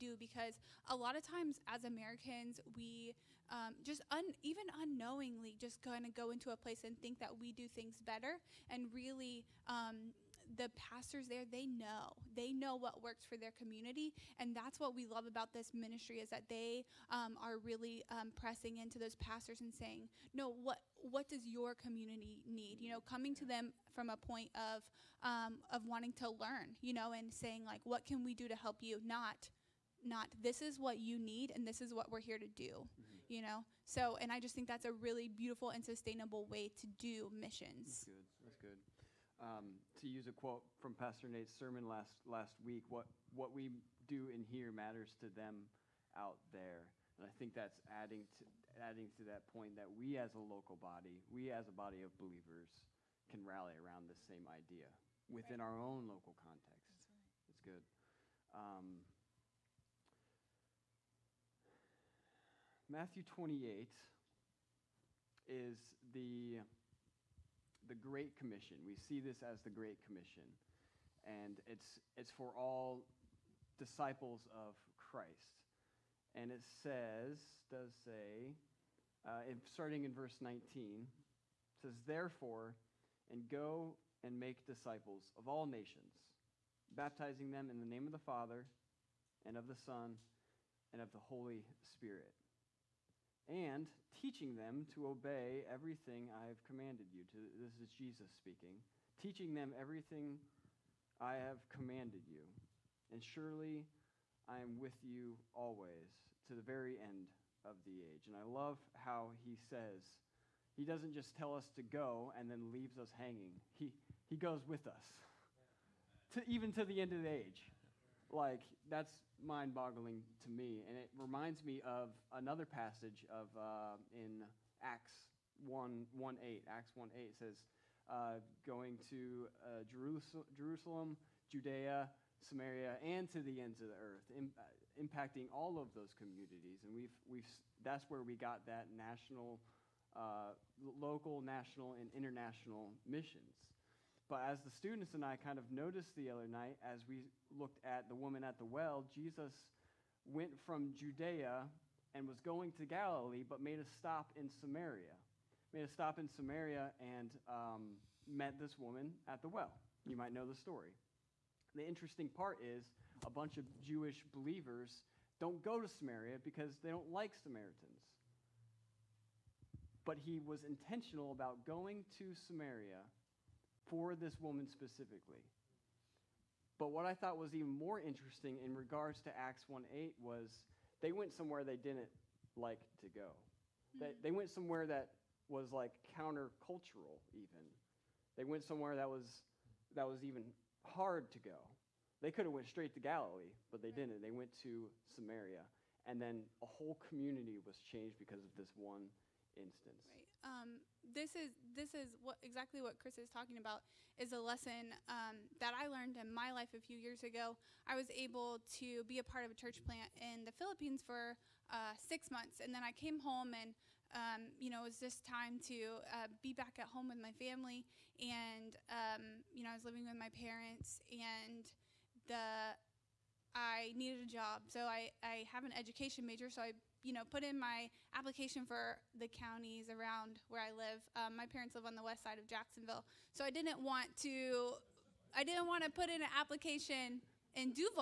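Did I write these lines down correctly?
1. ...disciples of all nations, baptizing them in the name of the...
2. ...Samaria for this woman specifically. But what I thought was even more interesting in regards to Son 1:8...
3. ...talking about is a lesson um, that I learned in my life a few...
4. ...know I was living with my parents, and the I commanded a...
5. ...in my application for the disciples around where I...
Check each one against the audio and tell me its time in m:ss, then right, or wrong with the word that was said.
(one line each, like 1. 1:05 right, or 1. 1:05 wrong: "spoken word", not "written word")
1. 1:24 right
2. 2:52 wrong: "Acts", not "Son"
3. 3:23 right
4. 3:39 wrong: "needed", not "commanded"
5. 3:47 wrong: "counties", not "disciples".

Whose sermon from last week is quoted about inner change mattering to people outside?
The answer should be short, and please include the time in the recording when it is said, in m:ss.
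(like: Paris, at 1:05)
Pastor Nate, at 0:40.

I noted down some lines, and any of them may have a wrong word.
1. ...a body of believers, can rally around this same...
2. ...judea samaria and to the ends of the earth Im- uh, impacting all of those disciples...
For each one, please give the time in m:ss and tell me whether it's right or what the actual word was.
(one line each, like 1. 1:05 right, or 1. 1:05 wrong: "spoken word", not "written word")
1. 0:51 right
2. 2:11 wrong: "communities", not "disciples".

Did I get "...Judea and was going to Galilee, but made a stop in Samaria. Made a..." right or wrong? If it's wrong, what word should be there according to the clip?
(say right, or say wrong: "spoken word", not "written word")
right.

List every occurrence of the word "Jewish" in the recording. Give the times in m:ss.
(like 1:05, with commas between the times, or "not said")
2:43.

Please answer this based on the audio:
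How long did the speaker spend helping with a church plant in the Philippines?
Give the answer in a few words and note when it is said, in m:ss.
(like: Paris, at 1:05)
6 months, at 3:31.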